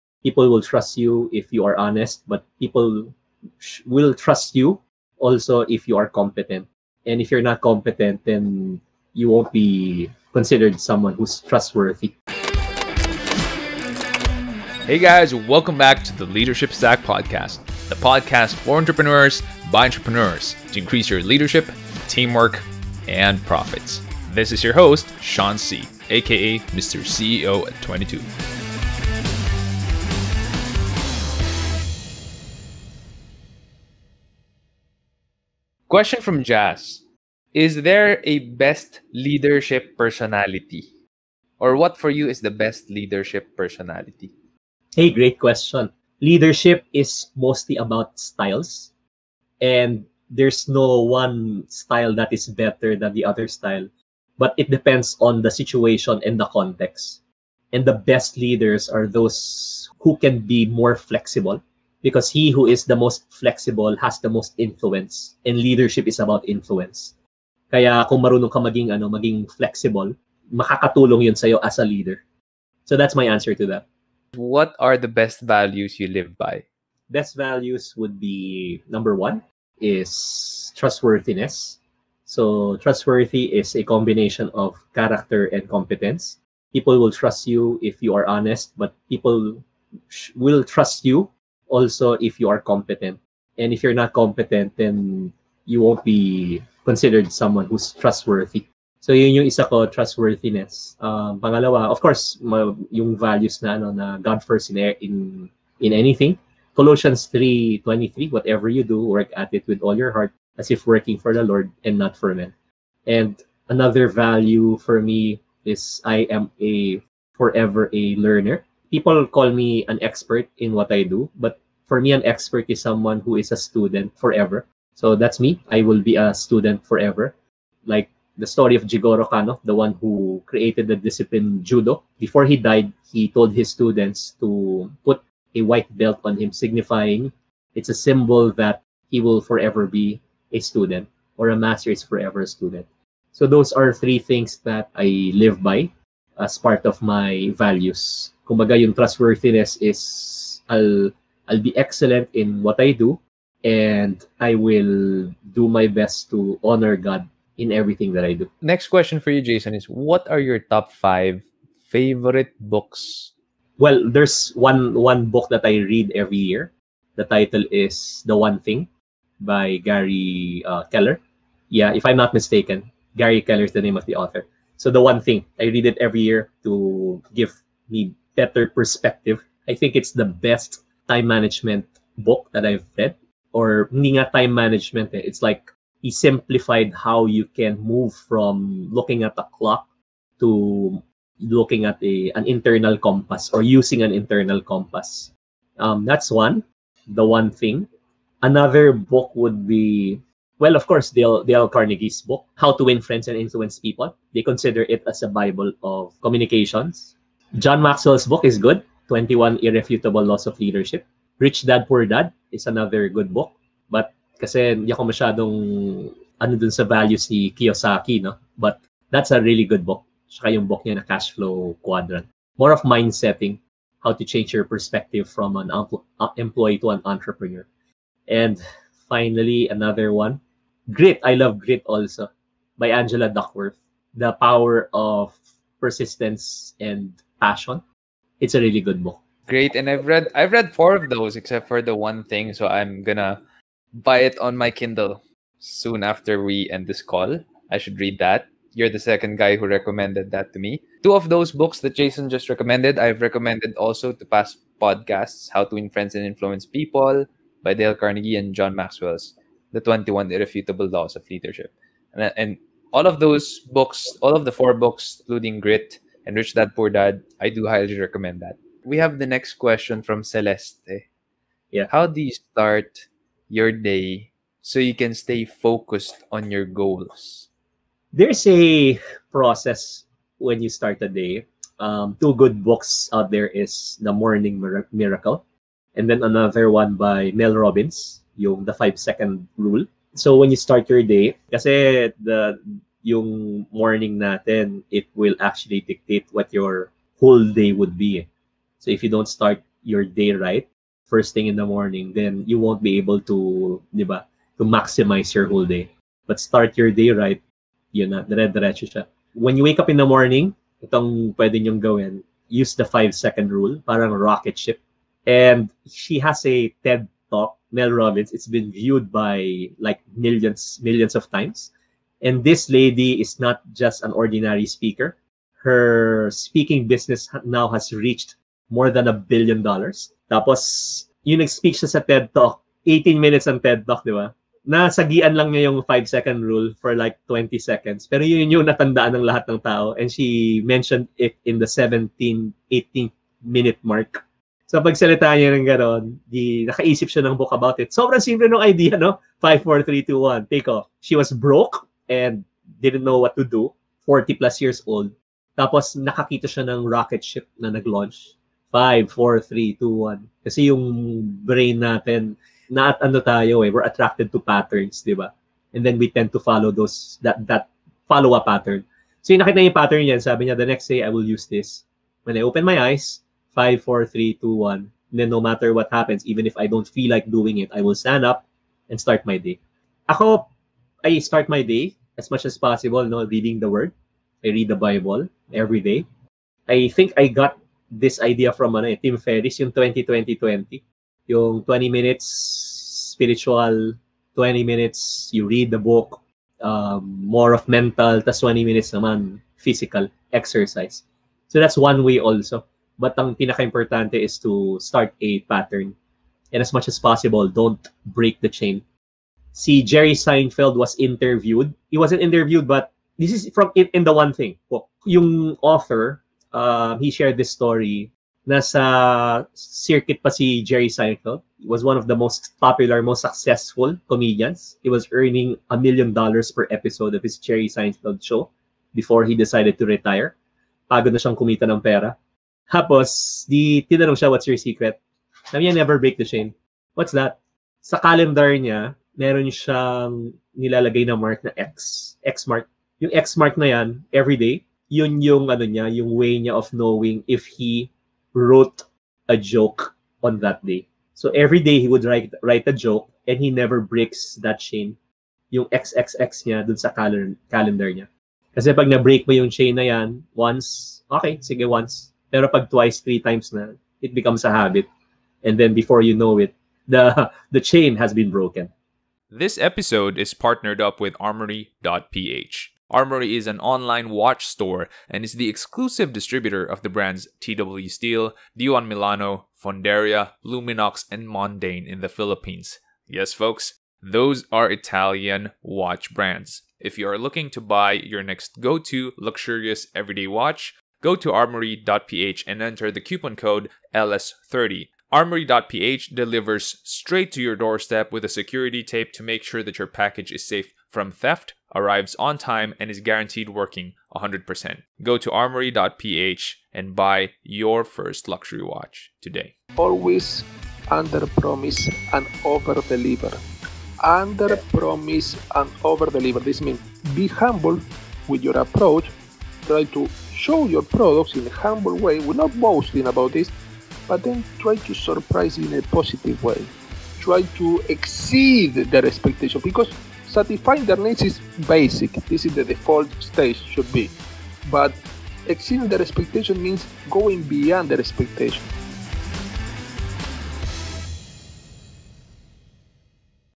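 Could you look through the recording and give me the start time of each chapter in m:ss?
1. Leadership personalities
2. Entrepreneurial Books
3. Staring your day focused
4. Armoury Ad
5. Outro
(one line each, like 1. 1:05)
1. 0:37
2. 2:14
3. 4:40
4. 7:50
5. 8:30.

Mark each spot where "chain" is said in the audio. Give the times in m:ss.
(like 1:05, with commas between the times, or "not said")
6:48, 7:16, 7:34, 7:39, 7:47.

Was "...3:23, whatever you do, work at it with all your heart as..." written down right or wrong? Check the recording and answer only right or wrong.
right.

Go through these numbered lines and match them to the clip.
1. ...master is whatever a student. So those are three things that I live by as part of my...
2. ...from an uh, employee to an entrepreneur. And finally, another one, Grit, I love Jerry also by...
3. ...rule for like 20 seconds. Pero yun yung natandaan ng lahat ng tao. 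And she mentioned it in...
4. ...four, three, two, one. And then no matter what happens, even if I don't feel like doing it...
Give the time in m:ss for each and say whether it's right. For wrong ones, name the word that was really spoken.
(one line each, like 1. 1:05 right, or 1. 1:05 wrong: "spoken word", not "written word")
1. 2:21 wrong: "forever", not "whatever"
2. 3:45 wrong: "Grit", not "Jerry"
3. 5:36 right
4. 6:13 right.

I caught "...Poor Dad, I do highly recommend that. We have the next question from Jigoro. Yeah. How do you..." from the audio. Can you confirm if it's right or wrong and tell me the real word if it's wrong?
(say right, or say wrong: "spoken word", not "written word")
wrong: "Celeste", not "Jigoro".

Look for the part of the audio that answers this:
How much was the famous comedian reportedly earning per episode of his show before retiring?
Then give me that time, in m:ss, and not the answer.
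7:05.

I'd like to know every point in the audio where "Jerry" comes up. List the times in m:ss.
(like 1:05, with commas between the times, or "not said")
6:49, 7:00, 7:07.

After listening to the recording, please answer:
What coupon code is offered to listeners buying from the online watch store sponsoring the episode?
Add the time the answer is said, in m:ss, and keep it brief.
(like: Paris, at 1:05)
LS30, at 8:13.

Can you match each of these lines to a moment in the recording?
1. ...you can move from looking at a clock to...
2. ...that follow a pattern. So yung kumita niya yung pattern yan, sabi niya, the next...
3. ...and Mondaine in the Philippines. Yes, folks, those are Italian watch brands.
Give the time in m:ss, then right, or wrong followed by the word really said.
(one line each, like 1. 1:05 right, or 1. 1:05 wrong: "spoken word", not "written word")
1. 3:07 right
2. 6:07 wrong: "nakita", not "kumita"
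3. 8:01 right.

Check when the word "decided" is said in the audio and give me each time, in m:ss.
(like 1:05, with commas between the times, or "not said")
7:09.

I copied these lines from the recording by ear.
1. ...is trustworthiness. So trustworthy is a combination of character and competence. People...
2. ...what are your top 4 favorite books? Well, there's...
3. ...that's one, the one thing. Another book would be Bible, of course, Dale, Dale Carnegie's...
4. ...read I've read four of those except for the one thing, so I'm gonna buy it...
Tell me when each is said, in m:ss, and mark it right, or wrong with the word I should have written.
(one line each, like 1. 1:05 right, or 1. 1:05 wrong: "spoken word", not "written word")
1. 1:19 right
2. 2:39 wrong: "5", not "4"
3. 3:16 wrong: "Well", not "Bible"
4. 4:00 right.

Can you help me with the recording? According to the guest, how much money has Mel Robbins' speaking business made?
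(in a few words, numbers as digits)
More than a billion dollars.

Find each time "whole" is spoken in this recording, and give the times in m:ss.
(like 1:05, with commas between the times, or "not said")
4:57, 5:05.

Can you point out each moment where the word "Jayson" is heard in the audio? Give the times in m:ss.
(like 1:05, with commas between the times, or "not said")
2:39, 4:11.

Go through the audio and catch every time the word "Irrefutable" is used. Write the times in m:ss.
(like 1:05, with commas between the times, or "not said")
3:29, 4:20.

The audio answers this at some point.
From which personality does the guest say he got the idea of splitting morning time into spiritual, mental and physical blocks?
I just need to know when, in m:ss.
6:28.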